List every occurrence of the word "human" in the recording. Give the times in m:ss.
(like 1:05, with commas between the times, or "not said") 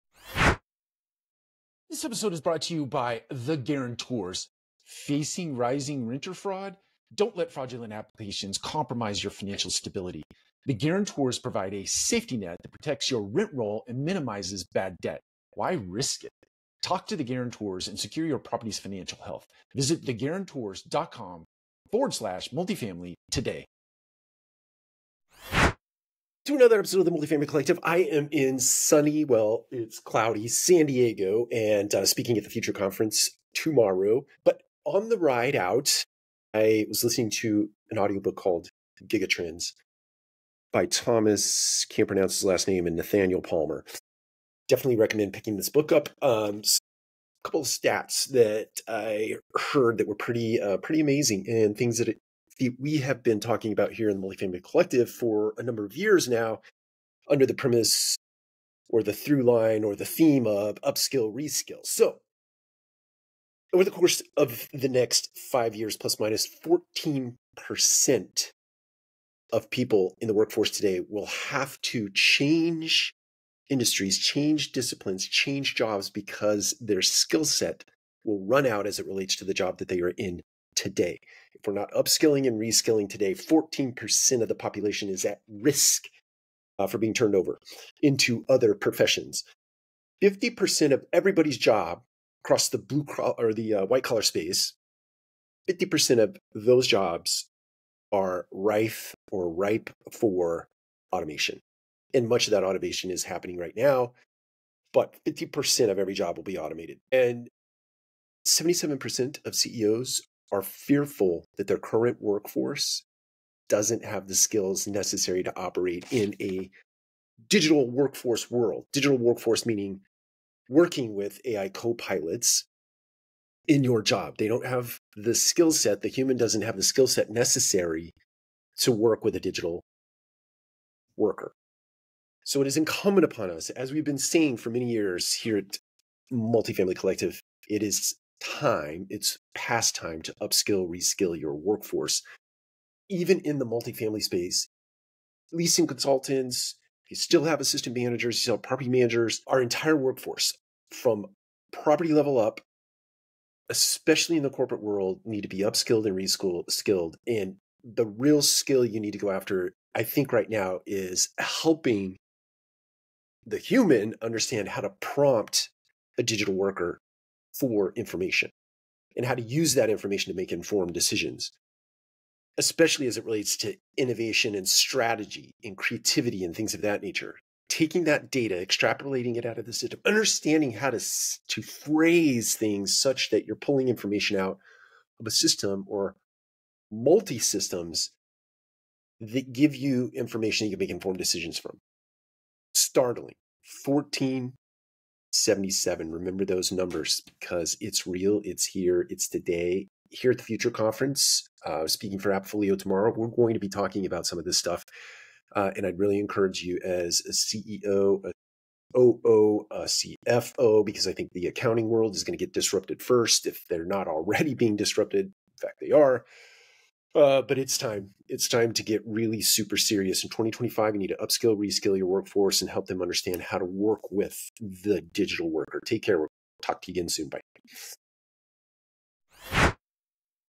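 2:06, 2:43.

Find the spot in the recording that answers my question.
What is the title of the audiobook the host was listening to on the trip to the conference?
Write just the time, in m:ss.
0:39.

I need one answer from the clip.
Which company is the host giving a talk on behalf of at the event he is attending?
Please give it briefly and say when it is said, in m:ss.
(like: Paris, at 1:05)
Appfolio, at 3:22.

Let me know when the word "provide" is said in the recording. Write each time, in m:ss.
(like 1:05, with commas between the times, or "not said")
0:11.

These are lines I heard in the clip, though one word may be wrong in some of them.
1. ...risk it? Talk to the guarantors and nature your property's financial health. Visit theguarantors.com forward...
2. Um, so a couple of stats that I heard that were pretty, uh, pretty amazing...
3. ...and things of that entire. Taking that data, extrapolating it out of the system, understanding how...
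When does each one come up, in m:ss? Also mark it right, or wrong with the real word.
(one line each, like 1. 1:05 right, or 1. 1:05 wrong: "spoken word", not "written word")
1. 0:15 wrong: "secure", not "nature"
2. 0:46 right
3. 2:56 wrong: "nature", not "entire".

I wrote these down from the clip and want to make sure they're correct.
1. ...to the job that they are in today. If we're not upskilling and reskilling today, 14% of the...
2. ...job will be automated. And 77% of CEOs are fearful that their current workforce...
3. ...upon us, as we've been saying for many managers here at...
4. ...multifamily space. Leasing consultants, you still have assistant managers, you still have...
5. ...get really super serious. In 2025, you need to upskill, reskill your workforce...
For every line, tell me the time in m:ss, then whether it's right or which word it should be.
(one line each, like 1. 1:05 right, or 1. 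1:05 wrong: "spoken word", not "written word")
1. 1:19 right
2. 1:46 right
3. 2:13 wrong: "years", not "managers"
4. 2:23 right
5. 3:38 right.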